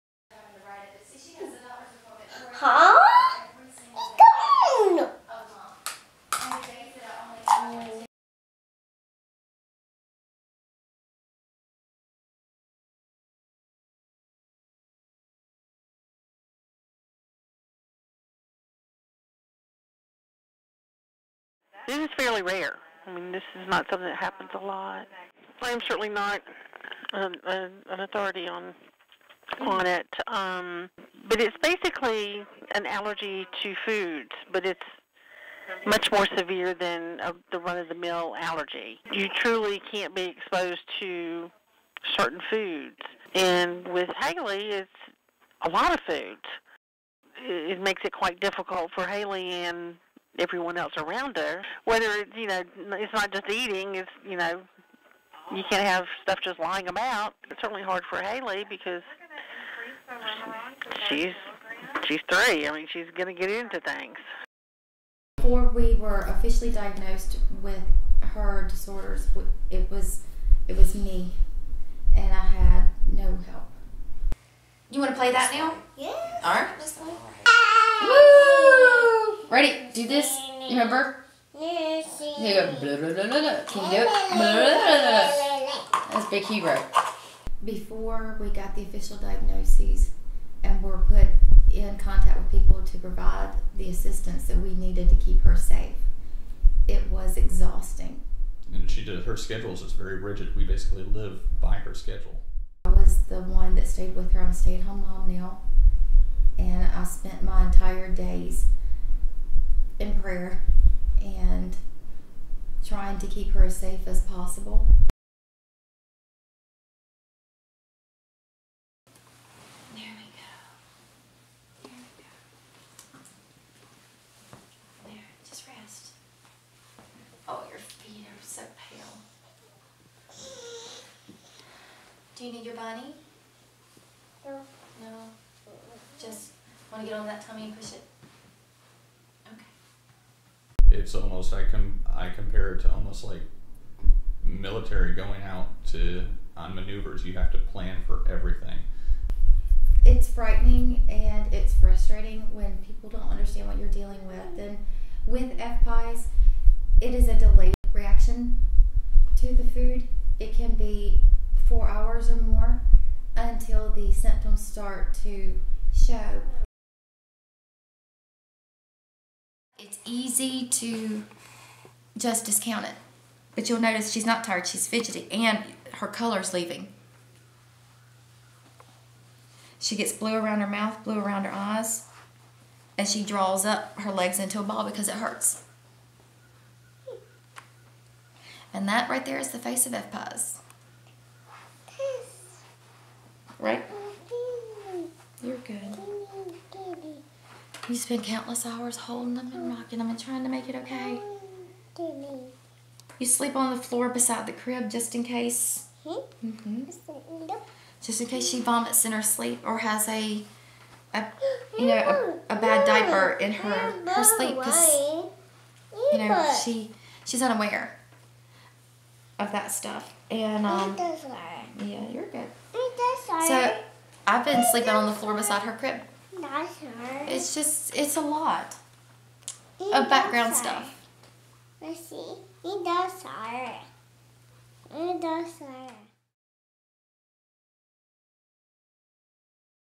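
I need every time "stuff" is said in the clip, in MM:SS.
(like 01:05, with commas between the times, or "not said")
00:56, 03:39, 03:50.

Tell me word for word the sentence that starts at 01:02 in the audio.
I mean, she's going to get into things.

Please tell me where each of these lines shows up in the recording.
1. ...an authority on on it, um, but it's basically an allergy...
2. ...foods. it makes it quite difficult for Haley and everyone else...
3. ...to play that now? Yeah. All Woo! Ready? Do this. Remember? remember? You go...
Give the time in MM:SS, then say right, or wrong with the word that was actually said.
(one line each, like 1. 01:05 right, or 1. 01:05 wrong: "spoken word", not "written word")
1. 00:27 right
2. 00:46 right
3. 01:15 right.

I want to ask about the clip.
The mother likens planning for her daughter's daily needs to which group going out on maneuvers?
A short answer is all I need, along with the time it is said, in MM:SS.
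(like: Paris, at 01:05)
military, at 02:24.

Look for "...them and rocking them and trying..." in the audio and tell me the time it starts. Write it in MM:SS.
03:19.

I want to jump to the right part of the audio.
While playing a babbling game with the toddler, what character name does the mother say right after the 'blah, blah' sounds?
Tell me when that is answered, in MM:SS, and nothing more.
01:26.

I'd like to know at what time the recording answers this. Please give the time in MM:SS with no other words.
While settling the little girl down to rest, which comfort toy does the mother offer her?
02:12.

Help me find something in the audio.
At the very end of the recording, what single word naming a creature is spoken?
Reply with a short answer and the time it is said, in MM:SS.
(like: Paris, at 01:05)
Dinosaur, at 03:54.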